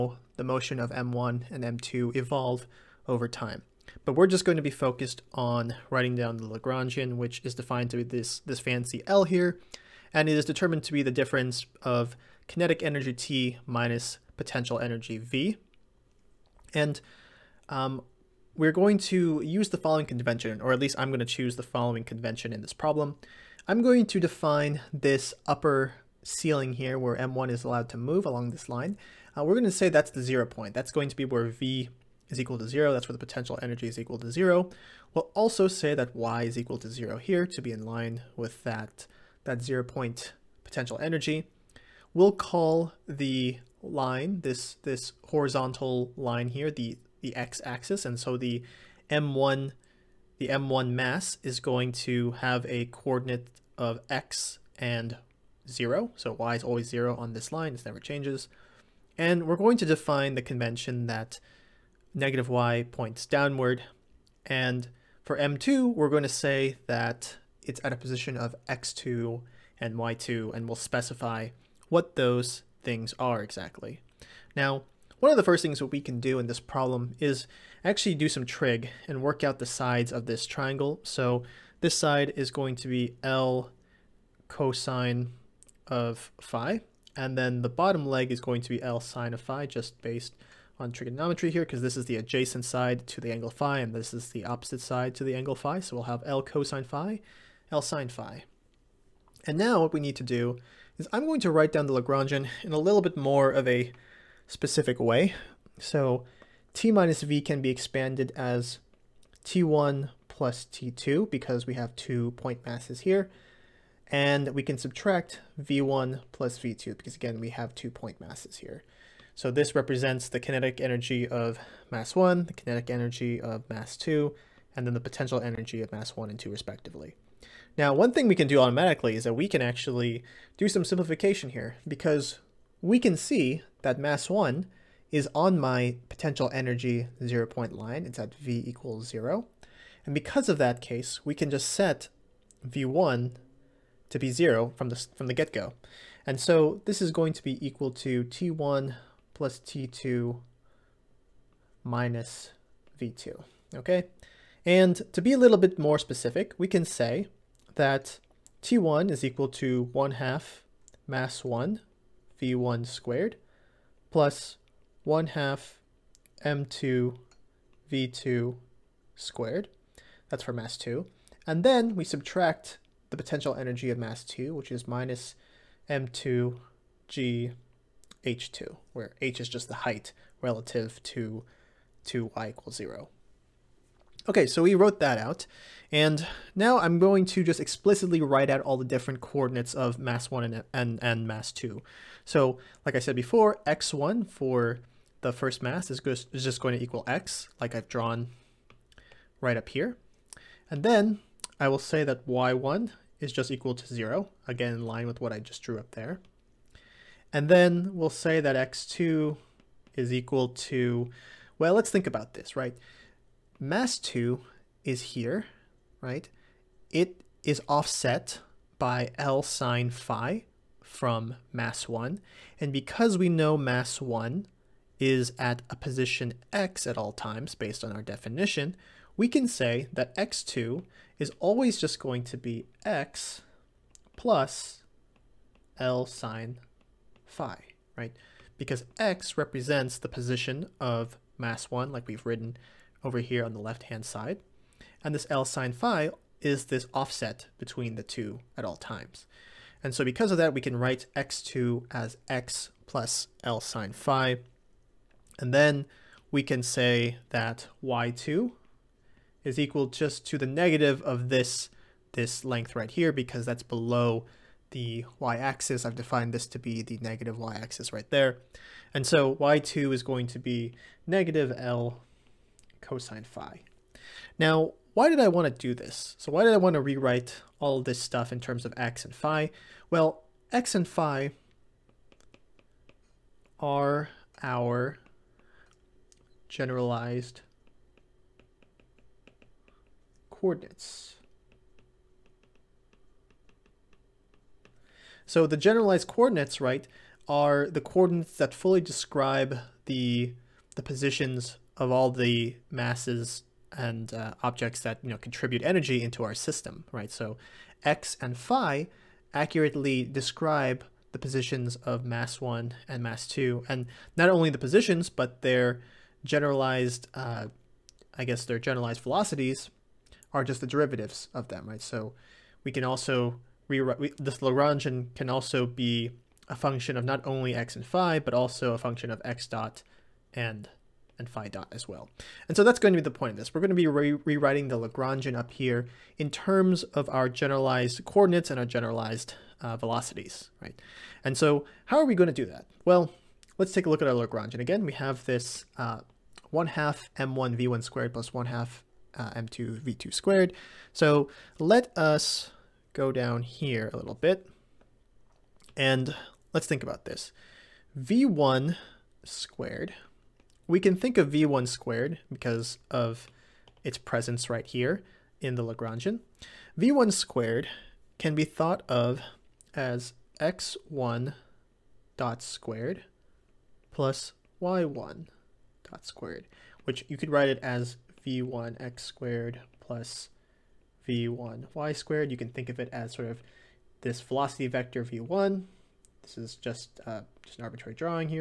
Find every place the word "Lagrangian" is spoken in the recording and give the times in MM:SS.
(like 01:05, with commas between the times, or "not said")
00:06, 01:42, 05:24, 05:34, 05:44, 06:05.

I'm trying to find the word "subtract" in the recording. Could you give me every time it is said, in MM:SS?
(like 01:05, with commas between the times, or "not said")
01:54, 02:52.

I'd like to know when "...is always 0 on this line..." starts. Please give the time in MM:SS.
00:56.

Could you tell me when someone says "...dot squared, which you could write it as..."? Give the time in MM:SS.
06:15.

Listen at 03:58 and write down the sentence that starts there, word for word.
Because x represents the position of mass 1, like we've written over here on the left-hand side.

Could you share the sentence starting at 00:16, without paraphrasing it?
And um, we're going to use the following convention, or at least I'm going to choose the following convention in this problem.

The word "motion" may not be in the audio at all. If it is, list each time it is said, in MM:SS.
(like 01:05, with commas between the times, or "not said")
00:00.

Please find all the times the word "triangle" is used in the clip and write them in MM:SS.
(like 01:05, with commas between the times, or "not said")
01:20.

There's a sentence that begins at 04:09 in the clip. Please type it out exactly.
And so because of that, we can write x2 as x plus L sine phi.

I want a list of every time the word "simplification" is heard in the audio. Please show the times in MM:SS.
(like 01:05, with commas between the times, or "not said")
02:10.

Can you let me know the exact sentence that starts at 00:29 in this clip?
Uh, we're going to say that's the zero point.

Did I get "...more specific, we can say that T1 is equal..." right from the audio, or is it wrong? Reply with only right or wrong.
right.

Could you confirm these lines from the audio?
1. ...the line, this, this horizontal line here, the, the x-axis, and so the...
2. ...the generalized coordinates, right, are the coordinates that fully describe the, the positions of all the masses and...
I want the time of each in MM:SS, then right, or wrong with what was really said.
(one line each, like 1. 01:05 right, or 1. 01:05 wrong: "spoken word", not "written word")
1. 00:43 right
2. 04:55 right.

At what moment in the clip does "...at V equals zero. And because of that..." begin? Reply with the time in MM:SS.
02:18.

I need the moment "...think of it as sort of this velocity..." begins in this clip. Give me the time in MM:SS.
06:22.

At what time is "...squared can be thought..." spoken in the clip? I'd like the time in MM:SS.
06:07.